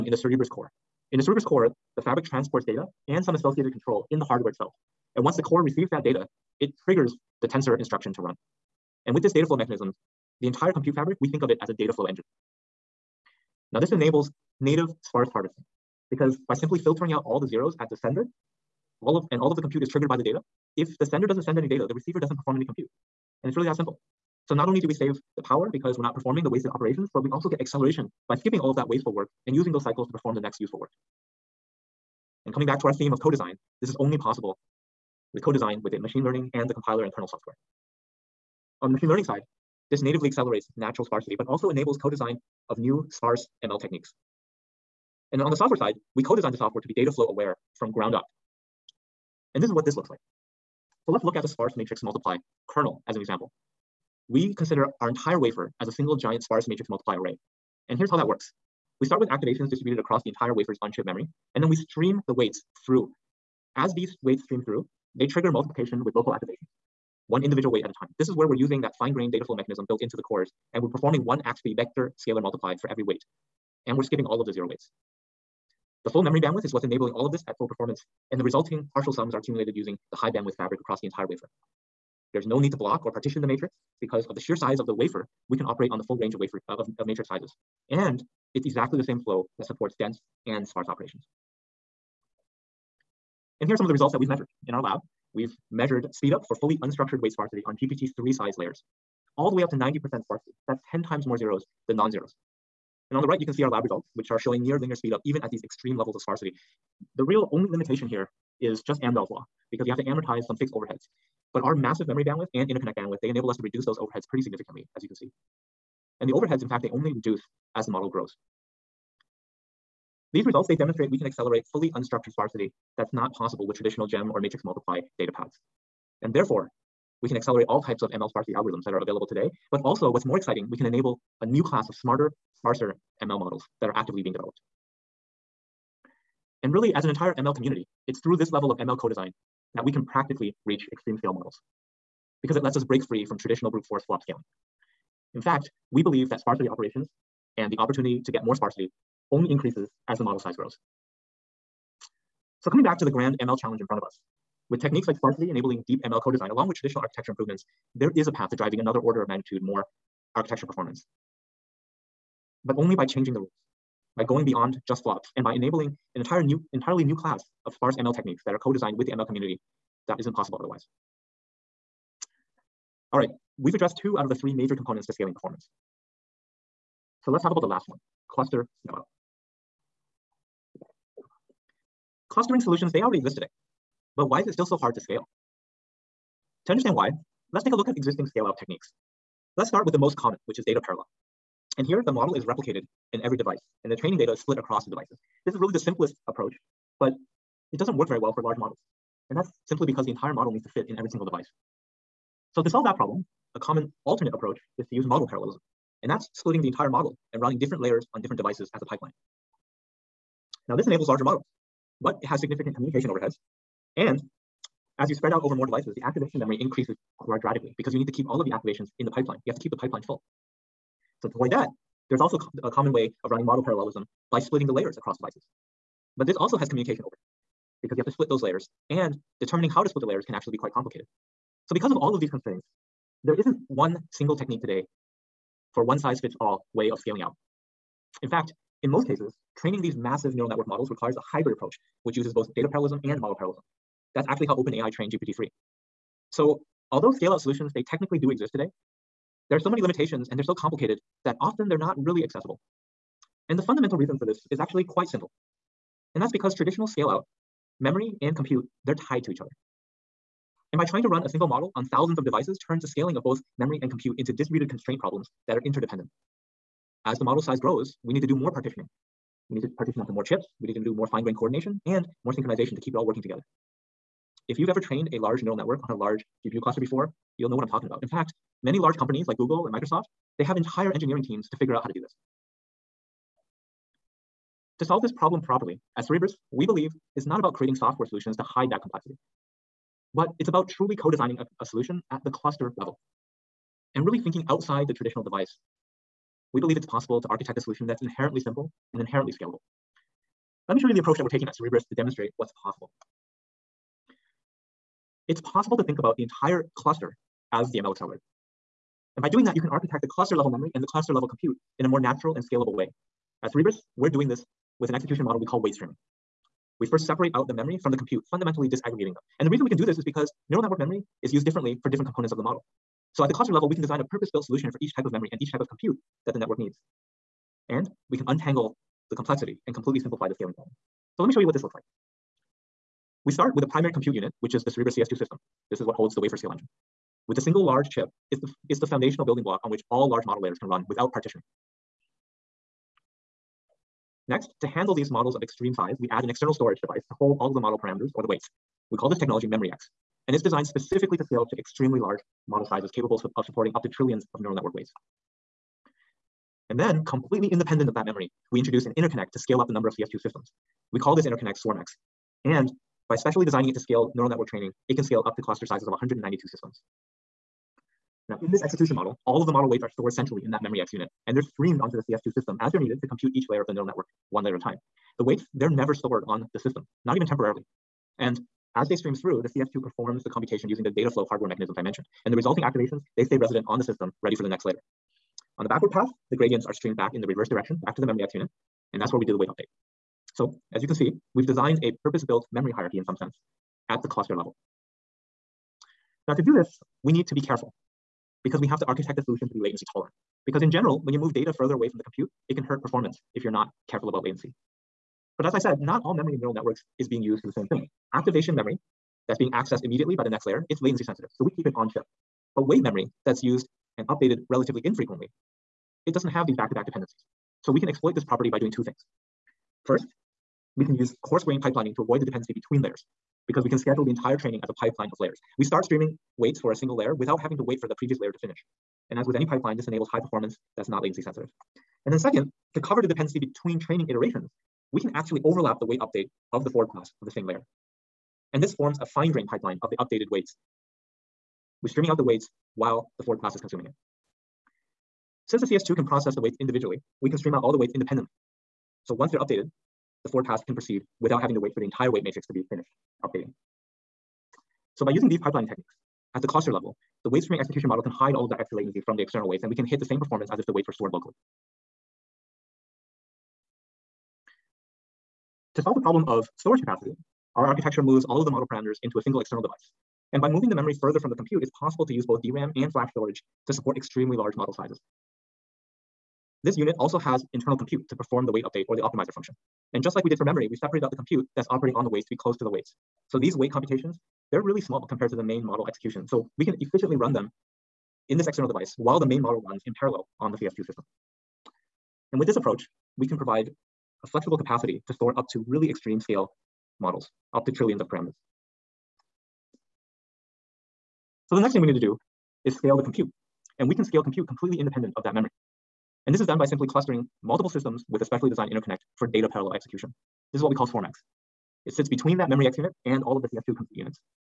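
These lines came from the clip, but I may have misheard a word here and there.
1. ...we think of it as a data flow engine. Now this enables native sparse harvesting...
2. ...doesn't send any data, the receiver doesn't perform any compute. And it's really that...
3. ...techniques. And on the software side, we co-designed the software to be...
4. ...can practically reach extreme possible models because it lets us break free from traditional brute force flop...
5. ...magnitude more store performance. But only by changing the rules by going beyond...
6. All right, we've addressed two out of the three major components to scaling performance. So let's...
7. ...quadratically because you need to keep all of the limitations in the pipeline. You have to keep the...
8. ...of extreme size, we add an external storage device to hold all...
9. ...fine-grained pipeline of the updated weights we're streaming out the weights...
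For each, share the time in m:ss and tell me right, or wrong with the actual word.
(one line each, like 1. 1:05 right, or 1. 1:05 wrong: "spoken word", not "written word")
1. 0:11 right
2. 0:21 right
3. 0:43 right
4. 2:19 wrong: "scale", not "possible"
5. 2:39 wrong: "architecture", not "store"
6. 2:53 right
7. 3:37 wrong: "activations", not "limitations"
8. 5:45 right
9. 7:19 right.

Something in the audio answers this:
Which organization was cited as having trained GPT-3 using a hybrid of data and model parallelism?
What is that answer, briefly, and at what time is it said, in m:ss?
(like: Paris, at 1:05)
OpenAI, at 4:04.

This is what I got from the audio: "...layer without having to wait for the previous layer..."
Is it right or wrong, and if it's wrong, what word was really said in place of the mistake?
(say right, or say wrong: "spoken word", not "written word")
right.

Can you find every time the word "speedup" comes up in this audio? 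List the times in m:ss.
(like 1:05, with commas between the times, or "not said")
1:36, 1:44.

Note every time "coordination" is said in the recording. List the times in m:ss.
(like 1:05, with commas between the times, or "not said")
4:31.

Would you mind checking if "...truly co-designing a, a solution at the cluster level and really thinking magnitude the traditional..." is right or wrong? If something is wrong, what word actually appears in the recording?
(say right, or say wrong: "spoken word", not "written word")
wrong: "outside", not "magnitude".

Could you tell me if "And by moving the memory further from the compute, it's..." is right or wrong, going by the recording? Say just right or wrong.
right.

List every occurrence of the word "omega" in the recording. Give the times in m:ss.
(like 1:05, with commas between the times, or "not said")
not said.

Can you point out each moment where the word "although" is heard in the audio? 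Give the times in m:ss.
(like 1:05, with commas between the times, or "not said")
4:06.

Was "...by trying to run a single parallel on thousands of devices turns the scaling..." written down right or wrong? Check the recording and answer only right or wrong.
wrong.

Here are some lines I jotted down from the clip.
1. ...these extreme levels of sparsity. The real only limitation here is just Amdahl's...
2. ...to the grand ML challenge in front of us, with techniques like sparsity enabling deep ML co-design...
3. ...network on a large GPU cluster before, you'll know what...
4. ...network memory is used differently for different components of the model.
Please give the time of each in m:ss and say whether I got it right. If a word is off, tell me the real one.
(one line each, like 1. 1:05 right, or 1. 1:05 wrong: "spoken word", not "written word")
1. 1:45 right
2. 2:32 right
3. 4:35 right
4. 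5:20 right.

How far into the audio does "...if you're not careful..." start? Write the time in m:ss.
6:43.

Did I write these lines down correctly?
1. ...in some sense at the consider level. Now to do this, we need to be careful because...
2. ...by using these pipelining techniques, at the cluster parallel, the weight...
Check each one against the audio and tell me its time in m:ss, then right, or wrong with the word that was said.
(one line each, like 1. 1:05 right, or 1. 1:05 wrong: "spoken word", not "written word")
1. 6:32 wrong: "cluster", not "consider"
2. 7:35 wrong: "level", not "parallel".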